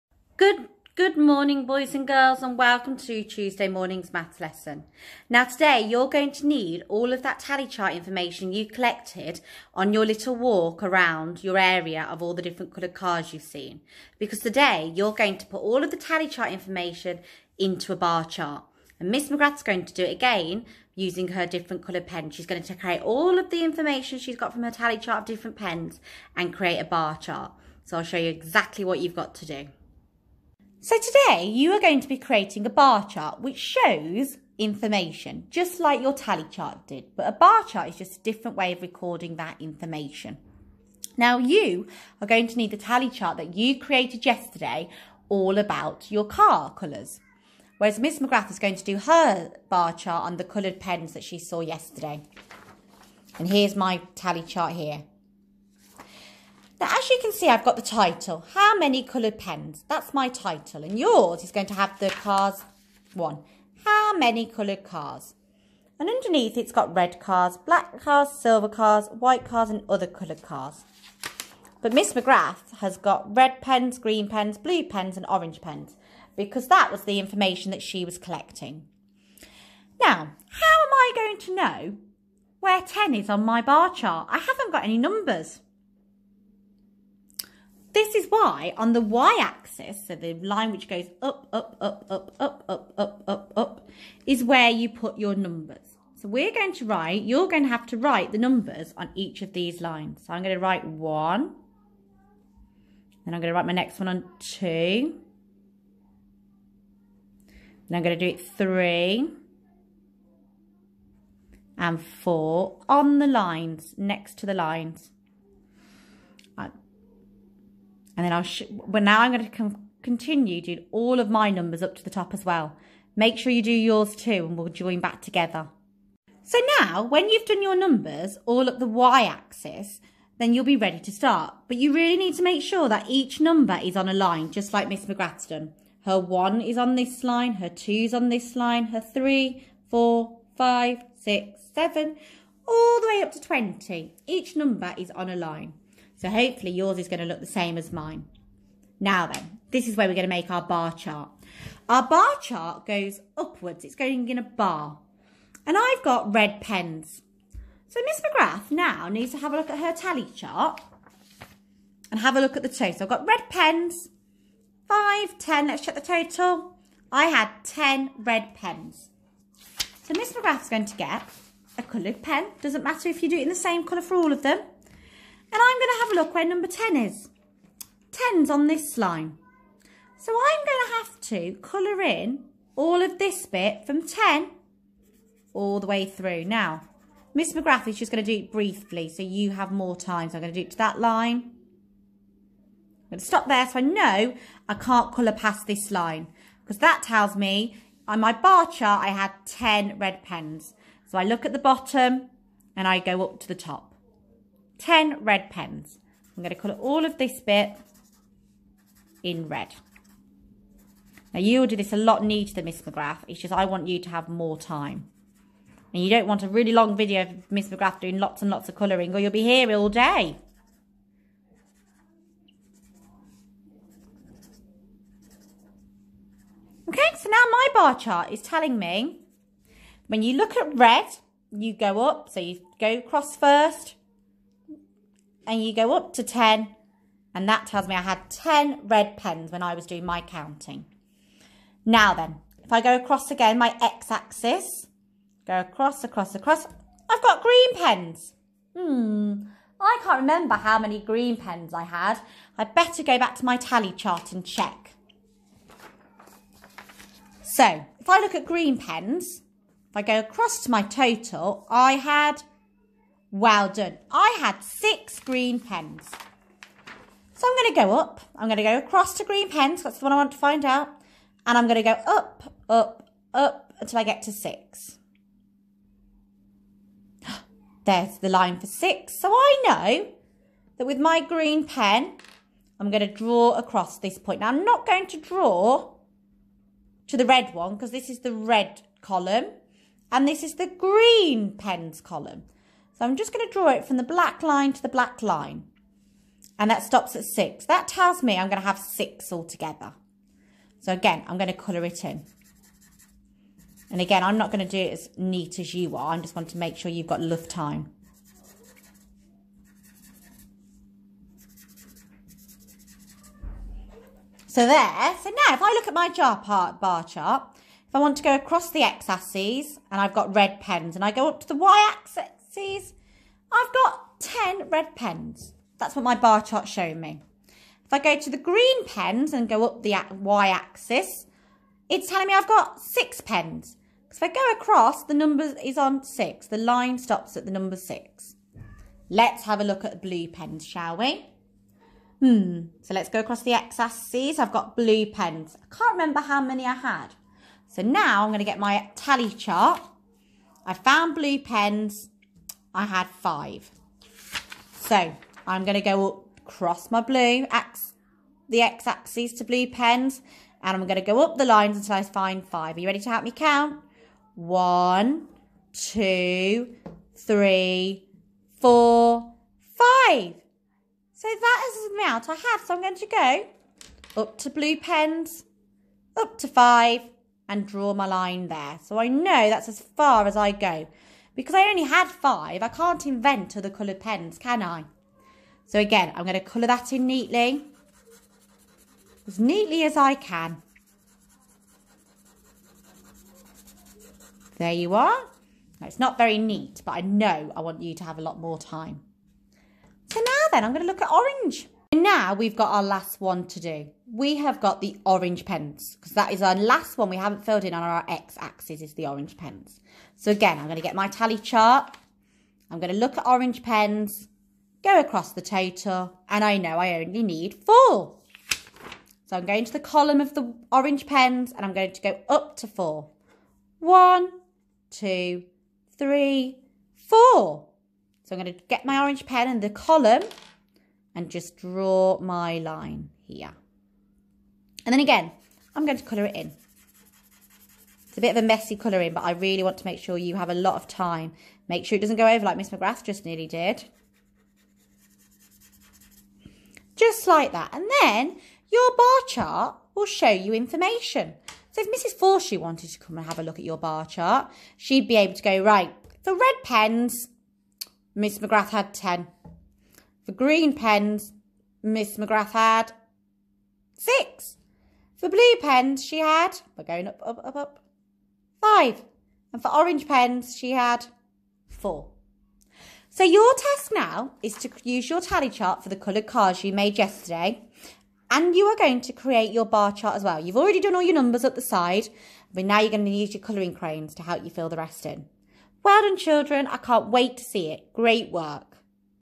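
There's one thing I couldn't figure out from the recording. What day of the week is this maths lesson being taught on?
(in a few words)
Tuesday.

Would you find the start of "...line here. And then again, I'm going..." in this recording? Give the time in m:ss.
7:12.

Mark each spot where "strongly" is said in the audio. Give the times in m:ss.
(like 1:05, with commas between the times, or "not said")
not said.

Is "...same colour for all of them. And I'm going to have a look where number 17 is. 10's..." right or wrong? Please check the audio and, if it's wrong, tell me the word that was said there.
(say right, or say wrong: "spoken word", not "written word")
wrong: "10", not "17".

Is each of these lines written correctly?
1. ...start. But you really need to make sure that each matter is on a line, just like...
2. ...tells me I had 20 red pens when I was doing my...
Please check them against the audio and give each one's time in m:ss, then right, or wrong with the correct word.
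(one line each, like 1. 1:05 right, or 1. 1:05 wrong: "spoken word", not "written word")
1. 2:11 wrong: "number", not "matter"
2. 3:57 wrong: "10", not "20".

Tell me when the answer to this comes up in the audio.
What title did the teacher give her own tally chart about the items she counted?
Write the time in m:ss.
0:58.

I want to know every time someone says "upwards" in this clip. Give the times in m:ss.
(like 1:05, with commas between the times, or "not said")
2:33.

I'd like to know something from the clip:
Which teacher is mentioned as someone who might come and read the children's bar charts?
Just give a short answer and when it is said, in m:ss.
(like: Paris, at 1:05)
Mrs. Forshaw, at 7:31.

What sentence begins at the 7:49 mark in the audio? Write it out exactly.
And for orange pens, she had four.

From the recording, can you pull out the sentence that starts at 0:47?
Whereas Miss McGrath is going to do her bar chart on the coloured pens that she saw yesterday.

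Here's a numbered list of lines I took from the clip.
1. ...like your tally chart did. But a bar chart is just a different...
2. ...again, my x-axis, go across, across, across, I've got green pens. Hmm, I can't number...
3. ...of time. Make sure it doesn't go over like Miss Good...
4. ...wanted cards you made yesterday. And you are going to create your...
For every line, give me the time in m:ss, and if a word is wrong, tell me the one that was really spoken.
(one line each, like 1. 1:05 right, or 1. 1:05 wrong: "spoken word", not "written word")
1. 0:35 right
2. 4:03 wrong: "remember", not "number"
3. 7:20 wrong: "McGrath", not "Good"
4. 7:55 wrong: "coloured", not "wanted".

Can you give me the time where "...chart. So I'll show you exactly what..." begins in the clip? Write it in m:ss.
0:27.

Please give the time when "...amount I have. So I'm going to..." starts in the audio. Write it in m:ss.
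6:11.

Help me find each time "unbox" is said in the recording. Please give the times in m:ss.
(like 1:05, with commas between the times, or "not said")
not said.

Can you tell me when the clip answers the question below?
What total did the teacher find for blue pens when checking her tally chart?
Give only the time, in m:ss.
5:52.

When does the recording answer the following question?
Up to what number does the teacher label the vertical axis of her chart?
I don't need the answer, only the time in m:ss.
2:23.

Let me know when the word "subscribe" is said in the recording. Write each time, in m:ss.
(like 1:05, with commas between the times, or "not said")
not said.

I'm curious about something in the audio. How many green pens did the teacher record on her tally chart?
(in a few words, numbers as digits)
6.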